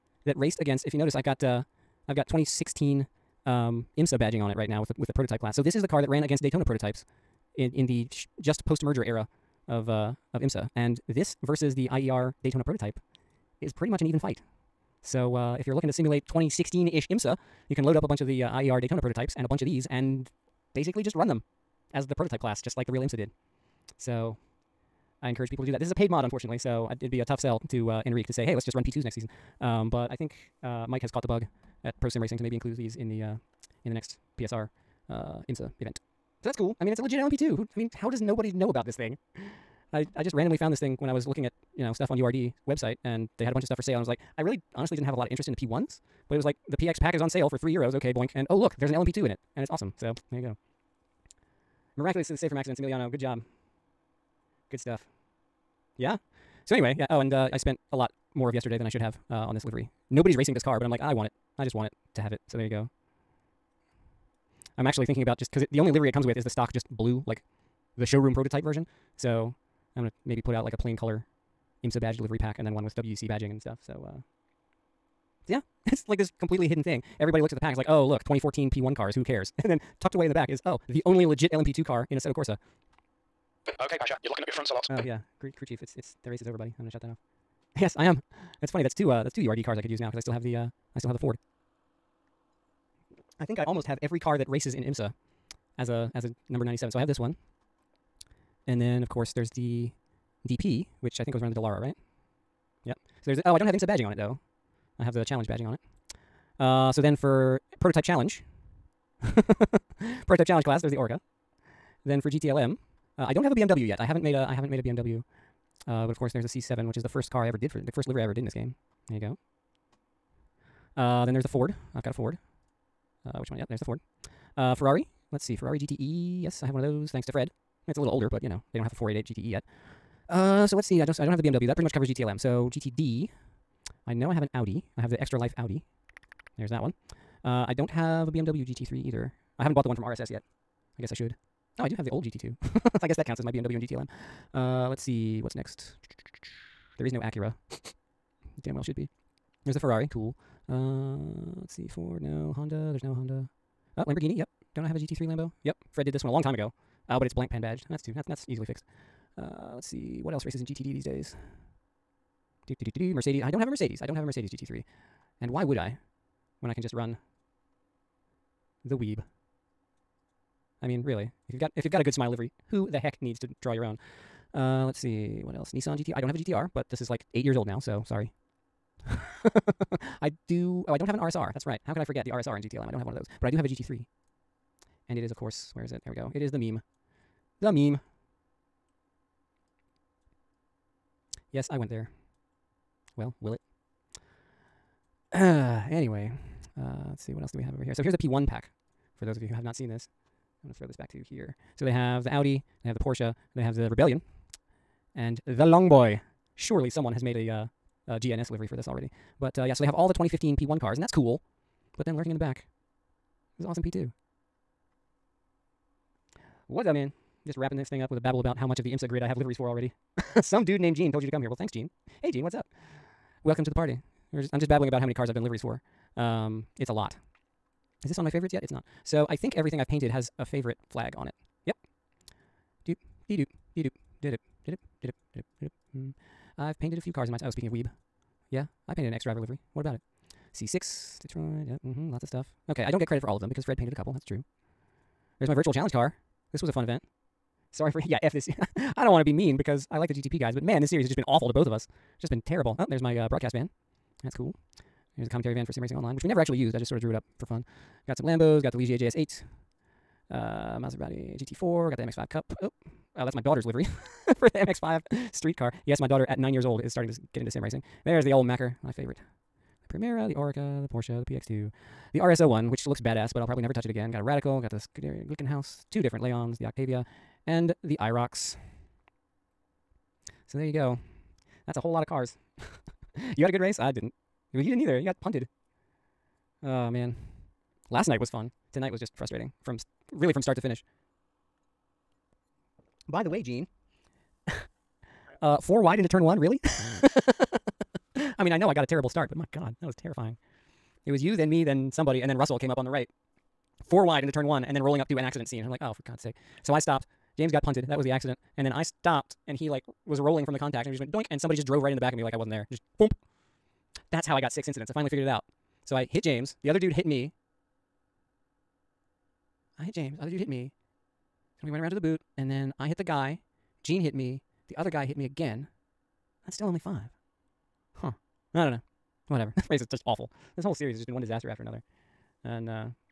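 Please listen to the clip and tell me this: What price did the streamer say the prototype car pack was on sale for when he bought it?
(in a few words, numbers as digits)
3 euros.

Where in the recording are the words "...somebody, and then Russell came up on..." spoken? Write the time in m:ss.
5:01.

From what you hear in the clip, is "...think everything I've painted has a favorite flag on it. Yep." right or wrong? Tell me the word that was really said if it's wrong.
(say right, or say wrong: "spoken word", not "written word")
right.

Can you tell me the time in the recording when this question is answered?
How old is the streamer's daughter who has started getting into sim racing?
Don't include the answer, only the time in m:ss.
4:26.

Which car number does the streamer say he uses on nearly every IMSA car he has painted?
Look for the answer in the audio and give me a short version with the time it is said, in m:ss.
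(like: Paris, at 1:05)
97, at 1:36.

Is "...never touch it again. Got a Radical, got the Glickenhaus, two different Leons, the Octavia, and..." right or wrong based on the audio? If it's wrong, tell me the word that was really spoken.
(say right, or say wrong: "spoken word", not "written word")
right.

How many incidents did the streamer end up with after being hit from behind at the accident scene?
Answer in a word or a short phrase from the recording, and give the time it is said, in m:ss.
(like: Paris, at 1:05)
6, at 5:14.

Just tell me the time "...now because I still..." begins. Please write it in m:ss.
1:29.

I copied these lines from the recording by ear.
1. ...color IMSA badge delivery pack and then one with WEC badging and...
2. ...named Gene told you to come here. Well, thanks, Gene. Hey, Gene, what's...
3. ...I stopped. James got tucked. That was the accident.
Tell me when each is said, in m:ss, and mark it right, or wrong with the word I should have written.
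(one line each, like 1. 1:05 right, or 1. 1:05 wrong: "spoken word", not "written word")
1. 1:10 right
2. 3:40 right
3. 5:06 wrong: "punted", not "tucked".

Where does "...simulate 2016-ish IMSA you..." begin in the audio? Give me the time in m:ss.
0:15.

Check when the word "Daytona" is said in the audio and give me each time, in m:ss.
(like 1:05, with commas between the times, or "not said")
0:06, 0:12, 0:18.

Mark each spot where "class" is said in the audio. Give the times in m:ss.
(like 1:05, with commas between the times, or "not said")
0:05, 0:22, 1:50.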